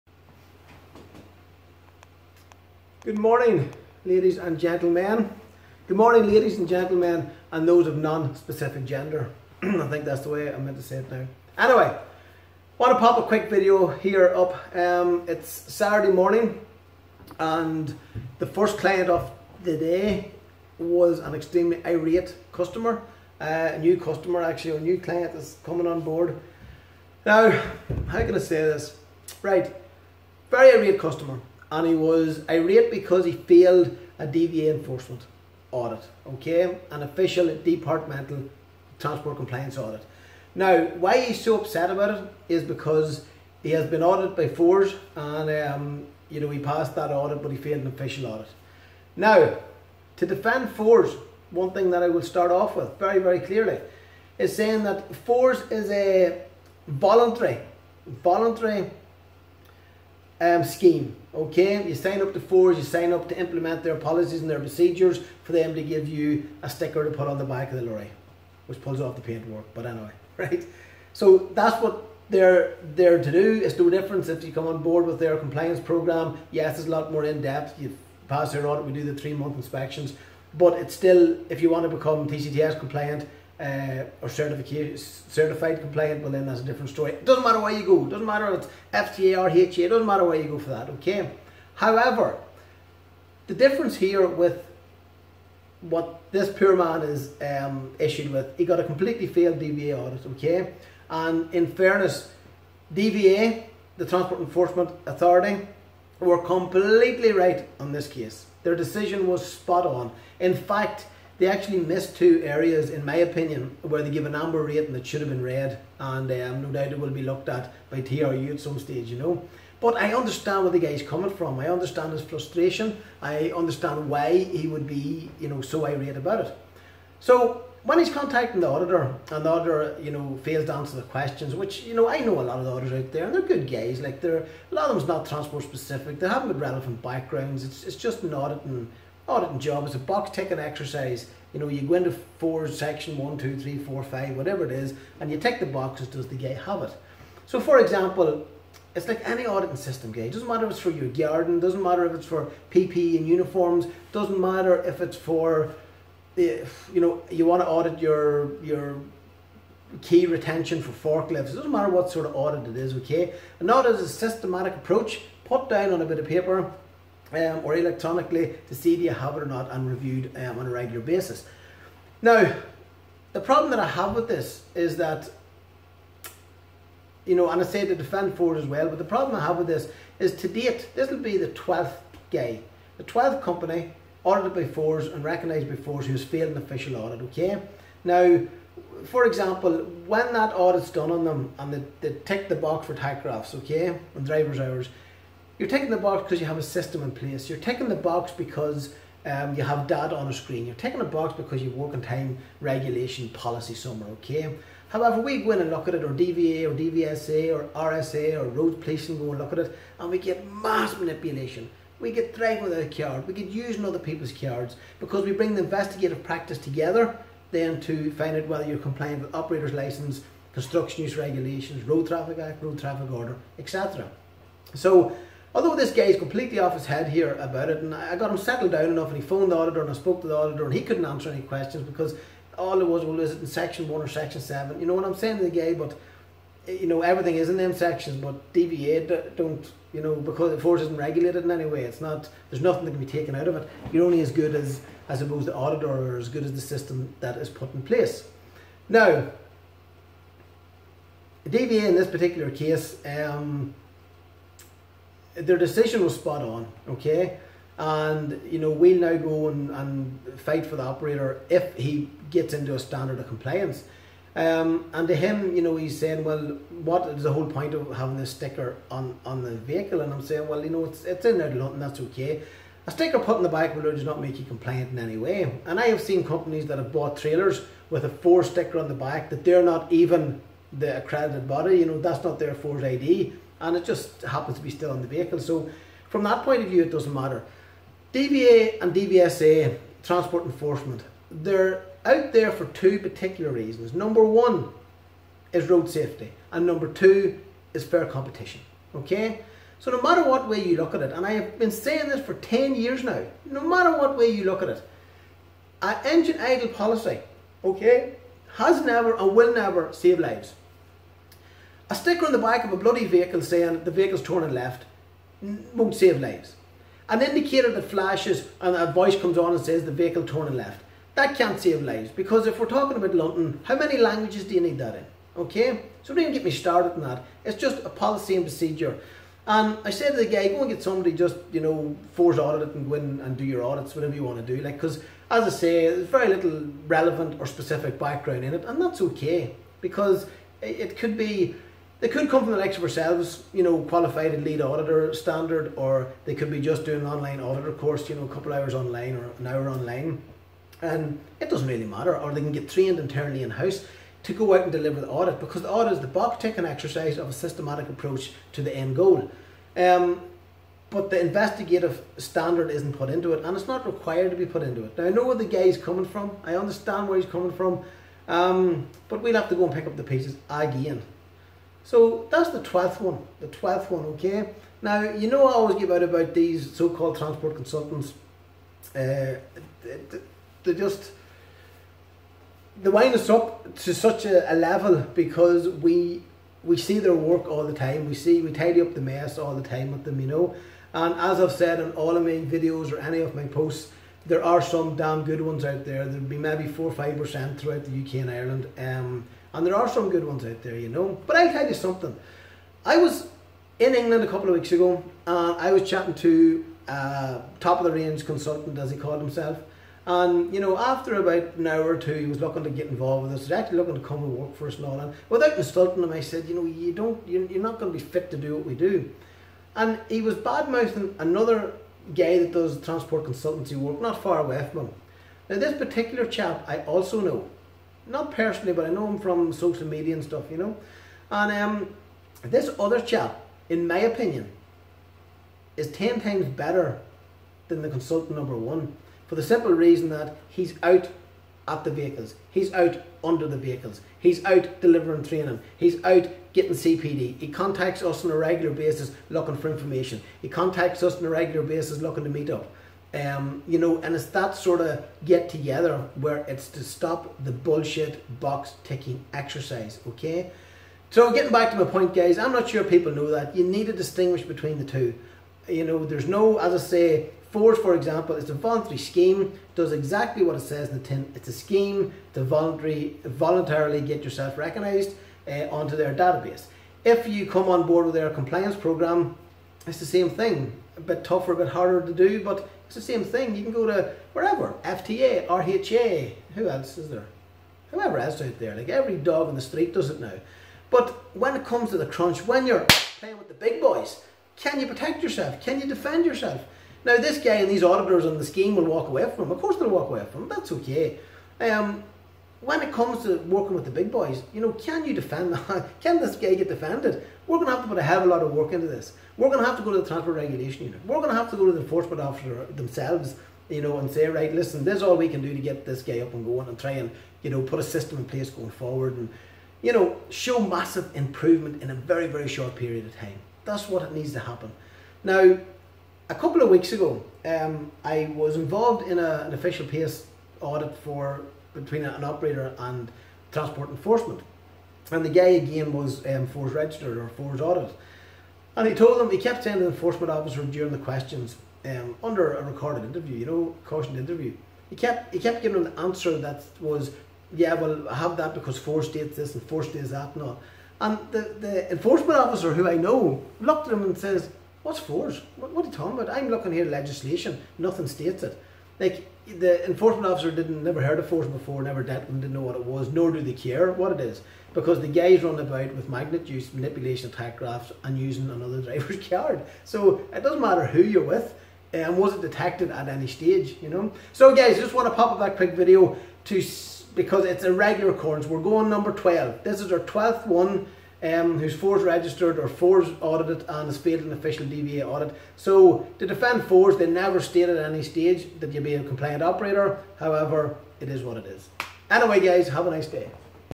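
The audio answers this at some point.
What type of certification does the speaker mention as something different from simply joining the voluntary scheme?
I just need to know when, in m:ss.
1:22.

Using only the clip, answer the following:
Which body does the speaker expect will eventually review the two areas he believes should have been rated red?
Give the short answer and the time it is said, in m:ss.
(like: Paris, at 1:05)
TRU, at 1:57.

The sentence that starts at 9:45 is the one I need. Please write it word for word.
So to defend FORS, they never stated at any stage that you'll be a compliant operator.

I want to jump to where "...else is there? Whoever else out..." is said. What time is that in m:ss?
8:06.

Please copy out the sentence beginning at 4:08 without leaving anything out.
Now, DVA in this particular case.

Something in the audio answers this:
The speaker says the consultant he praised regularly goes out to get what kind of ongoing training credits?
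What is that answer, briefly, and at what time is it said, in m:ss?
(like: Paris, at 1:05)
CPD, at 7:26.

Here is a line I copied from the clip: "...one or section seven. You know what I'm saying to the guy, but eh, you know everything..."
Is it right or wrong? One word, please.
right.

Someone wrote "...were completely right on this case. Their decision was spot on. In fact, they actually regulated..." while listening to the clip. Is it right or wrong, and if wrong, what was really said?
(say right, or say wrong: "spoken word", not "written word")
wrong: "missed", not "regulated".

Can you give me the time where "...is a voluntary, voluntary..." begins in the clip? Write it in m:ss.
0:55.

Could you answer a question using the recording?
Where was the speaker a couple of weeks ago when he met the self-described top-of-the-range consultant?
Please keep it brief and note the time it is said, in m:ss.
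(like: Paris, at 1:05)
England, at 6:43.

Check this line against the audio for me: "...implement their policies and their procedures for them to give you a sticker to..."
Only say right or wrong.
right.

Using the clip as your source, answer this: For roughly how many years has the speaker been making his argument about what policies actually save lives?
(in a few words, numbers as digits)
10 years.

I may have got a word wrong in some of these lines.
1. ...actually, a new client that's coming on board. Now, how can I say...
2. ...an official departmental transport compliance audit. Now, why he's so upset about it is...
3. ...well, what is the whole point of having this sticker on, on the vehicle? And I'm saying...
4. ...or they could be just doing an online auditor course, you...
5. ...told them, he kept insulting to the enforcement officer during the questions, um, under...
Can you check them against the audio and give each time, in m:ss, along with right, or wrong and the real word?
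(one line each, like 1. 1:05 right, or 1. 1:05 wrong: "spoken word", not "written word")
1. 0:24 right
2. 0:36 right
3. 4:26 right
4. 5:45 right
5. 8:58 wrong: "saying", not "insulting".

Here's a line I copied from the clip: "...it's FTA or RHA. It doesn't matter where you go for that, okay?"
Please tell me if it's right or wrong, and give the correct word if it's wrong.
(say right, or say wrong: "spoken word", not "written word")
right.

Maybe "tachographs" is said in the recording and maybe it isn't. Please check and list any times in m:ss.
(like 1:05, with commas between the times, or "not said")
3:12, 9:27.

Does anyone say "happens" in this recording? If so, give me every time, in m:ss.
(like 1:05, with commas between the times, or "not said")
4:44, 8:44.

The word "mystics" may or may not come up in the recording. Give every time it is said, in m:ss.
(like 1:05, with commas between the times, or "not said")
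not said.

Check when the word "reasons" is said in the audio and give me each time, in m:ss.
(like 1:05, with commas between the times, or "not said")
4:53, 7:19.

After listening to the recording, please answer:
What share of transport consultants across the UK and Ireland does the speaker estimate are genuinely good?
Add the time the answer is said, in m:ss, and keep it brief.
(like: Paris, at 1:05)
4 or 5 percent, at 6:36.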